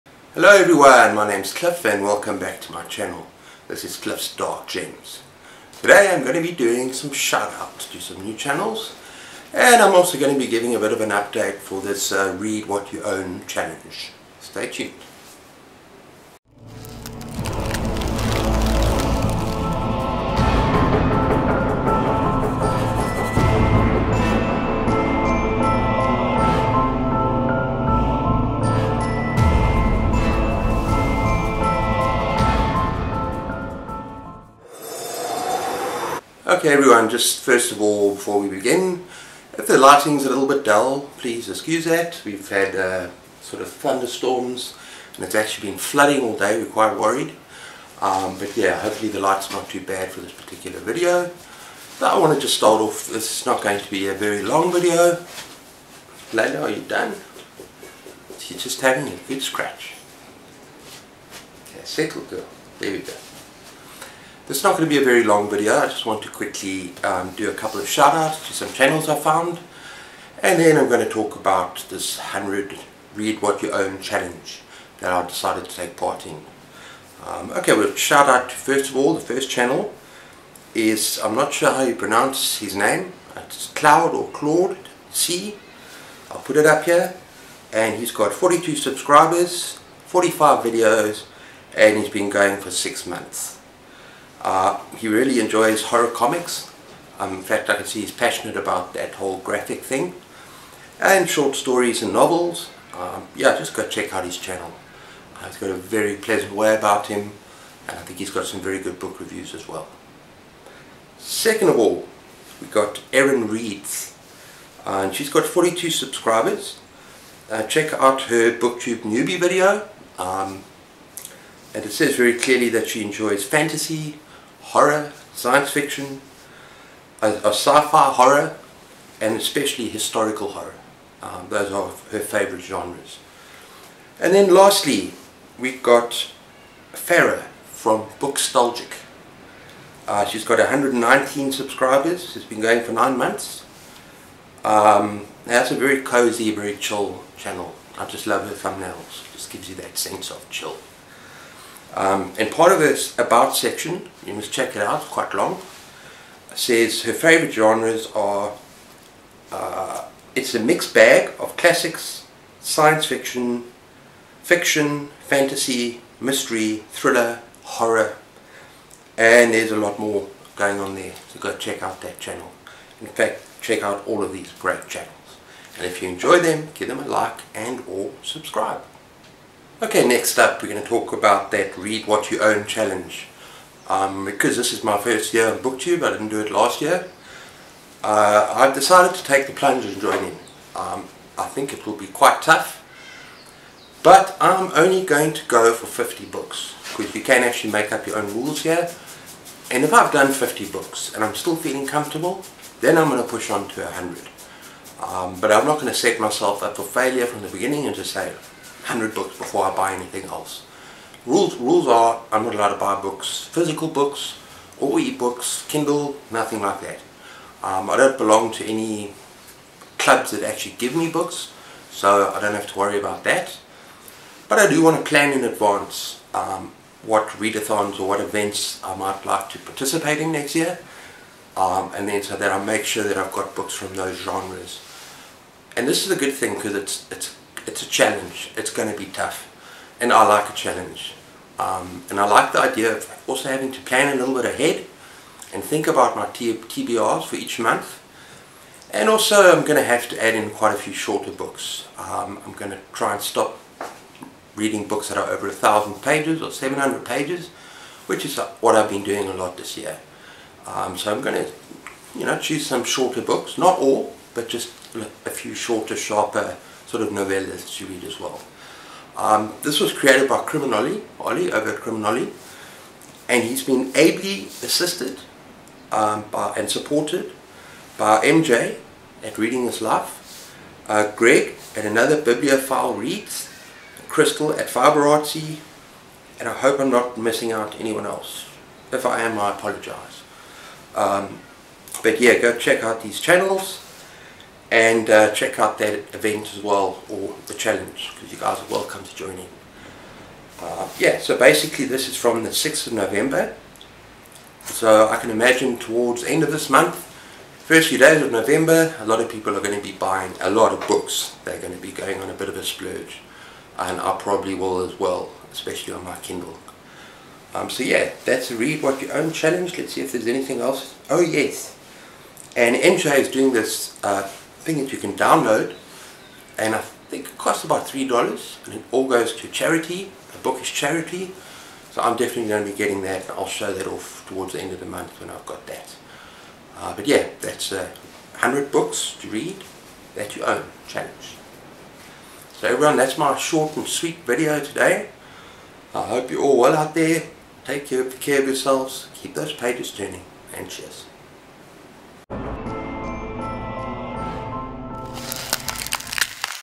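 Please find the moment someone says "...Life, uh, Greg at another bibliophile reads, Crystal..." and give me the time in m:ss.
4:39.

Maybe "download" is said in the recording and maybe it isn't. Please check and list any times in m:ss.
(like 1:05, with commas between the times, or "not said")
5:25.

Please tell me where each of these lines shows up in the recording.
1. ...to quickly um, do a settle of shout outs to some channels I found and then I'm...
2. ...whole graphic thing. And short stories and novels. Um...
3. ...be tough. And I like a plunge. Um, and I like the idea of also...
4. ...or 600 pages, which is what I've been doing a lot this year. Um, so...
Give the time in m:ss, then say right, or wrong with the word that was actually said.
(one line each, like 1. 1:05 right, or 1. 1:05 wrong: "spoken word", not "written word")
1. 1:06 wrong: "couple", not "settle"
2. 1:39 right
3. 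3:58 wrong: "challenge", not "plunge"
4. 4:16 wrong: "700", not "600".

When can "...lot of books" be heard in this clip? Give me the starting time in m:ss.
5:10.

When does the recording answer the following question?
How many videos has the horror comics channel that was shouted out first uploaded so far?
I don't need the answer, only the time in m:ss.
1:30.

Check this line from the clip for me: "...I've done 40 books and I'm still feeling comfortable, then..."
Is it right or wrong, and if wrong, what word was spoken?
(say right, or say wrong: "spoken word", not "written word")
wrong: "50", not "40".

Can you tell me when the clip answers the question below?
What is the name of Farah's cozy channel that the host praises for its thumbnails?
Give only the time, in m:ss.
2:18.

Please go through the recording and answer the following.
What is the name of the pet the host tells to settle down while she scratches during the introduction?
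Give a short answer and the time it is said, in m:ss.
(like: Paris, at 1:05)
Layla, at 0:56.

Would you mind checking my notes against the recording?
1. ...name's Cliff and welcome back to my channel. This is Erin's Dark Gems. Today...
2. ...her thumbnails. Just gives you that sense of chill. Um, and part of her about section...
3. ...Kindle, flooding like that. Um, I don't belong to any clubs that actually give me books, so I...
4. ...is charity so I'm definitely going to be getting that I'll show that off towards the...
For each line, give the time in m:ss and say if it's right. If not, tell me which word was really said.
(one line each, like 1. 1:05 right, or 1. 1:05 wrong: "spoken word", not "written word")
1. 0:01 wrong: "Cliff", not "Erin"
2. 2:28 right
3. 3:35 wrong: "nothing", not "flooding"
4. 5:30 right.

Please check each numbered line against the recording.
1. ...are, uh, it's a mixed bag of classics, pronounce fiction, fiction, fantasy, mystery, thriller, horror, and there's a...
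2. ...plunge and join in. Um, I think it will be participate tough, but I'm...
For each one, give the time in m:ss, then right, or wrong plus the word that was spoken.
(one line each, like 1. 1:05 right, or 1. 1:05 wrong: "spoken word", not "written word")
1. 2:38 wrong: "science", not "pronounce"
2. 3:09 wrong: "quite", not "participate".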